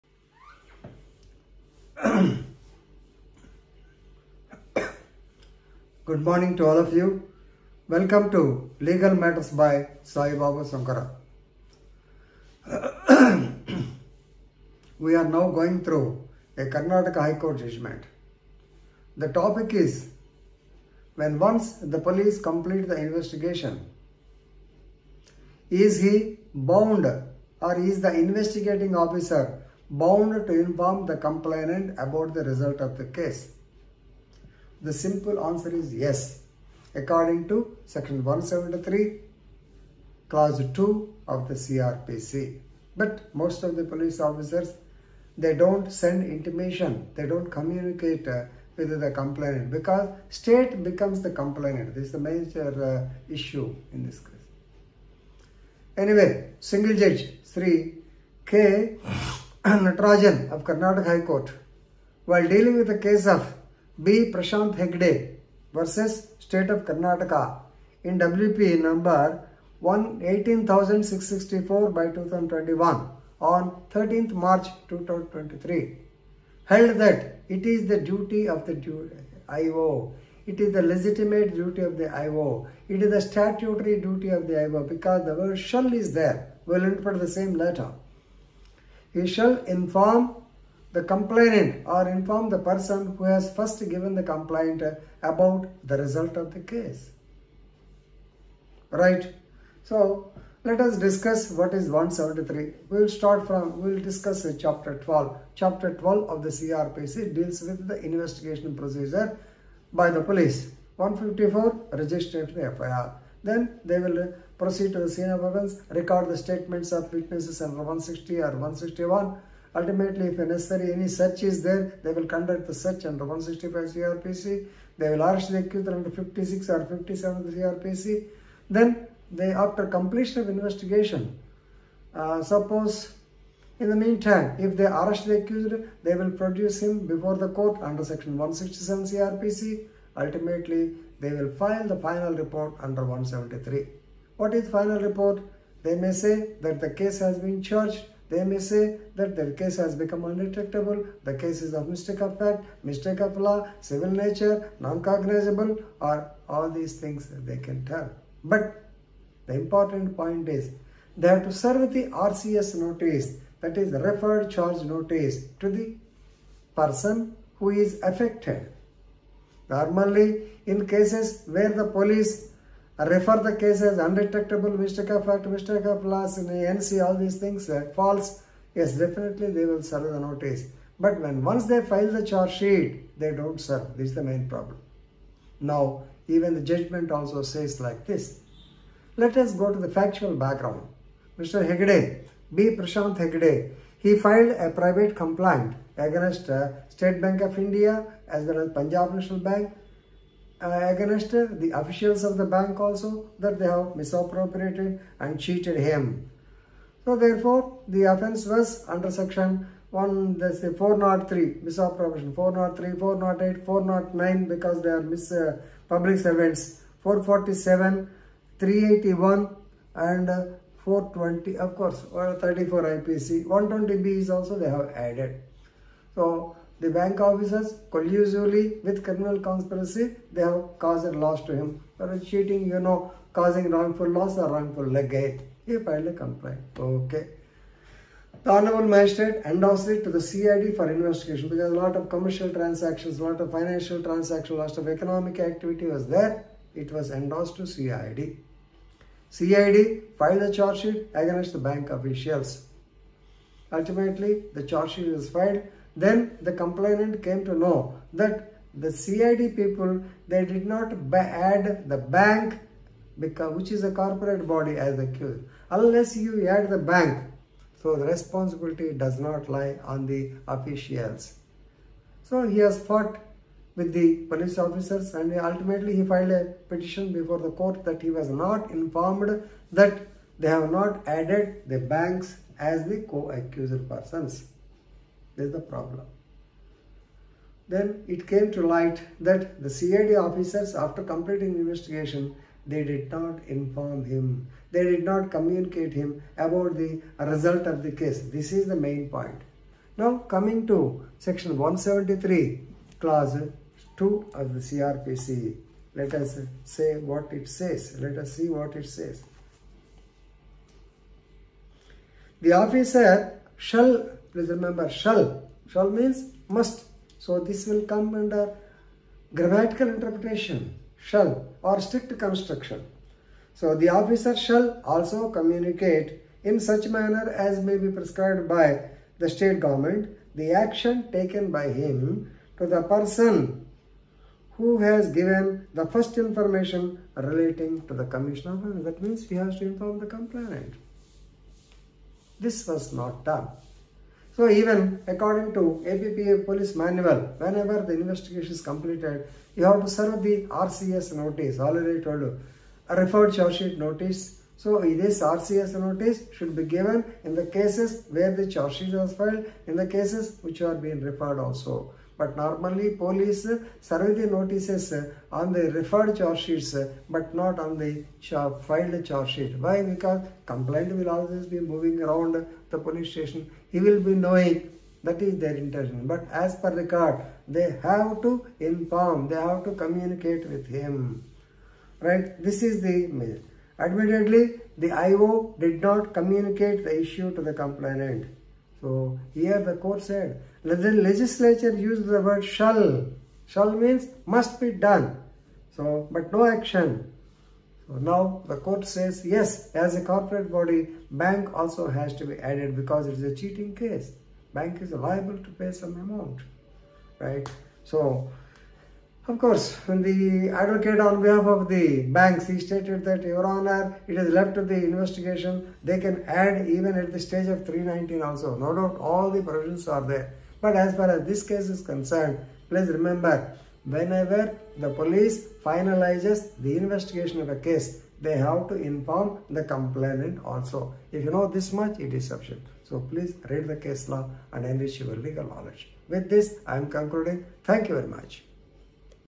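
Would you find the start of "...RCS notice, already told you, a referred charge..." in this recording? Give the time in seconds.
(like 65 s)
350 s.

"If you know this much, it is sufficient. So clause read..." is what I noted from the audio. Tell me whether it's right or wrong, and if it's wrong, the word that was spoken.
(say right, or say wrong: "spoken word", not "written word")
wrong: "please", not "clause".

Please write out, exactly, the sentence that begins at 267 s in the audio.
So the responsibility does not lie on the officials.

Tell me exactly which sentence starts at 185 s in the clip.
Now, even the judgment also says like this.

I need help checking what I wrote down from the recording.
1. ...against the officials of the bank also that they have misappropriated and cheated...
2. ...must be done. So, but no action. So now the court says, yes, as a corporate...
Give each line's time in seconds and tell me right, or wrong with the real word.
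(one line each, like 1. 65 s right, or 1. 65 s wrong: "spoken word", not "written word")
1. 200 s right
2. 394 s right.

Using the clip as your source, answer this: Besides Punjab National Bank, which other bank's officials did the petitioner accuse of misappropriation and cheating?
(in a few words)
State Bank of India.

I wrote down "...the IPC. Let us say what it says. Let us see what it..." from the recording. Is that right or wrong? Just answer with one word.
wrong.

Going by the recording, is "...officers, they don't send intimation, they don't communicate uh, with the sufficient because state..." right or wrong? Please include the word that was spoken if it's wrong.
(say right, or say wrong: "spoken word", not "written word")
wrong: "complainant", not "sufficient".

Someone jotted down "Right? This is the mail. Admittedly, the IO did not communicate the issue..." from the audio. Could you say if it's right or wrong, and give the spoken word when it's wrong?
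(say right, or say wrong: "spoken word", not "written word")
right.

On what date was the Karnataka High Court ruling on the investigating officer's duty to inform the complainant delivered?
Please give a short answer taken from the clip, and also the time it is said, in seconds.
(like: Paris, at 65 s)
13 March 2023, at 73 s.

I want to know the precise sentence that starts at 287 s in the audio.
Then it came to light that the CID officers, after completing investigation, they did not inform him.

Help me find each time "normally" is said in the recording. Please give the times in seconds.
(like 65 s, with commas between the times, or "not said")
169 s, 362 s.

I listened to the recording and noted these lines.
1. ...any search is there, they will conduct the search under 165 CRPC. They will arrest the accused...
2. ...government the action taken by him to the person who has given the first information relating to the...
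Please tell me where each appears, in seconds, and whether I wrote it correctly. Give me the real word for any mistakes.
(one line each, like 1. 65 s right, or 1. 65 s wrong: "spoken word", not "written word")
1. 120 s right
2. 329 s right.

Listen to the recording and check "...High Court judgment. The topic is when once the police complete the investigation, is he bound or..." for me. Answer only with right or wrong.
right.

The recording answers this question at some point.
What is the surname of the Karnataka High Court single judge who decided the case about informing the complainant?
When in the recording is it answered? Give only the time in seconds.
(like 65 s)
59 s.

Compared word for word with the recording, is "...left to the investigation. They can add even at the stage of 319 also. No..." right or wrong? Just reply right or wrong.
right.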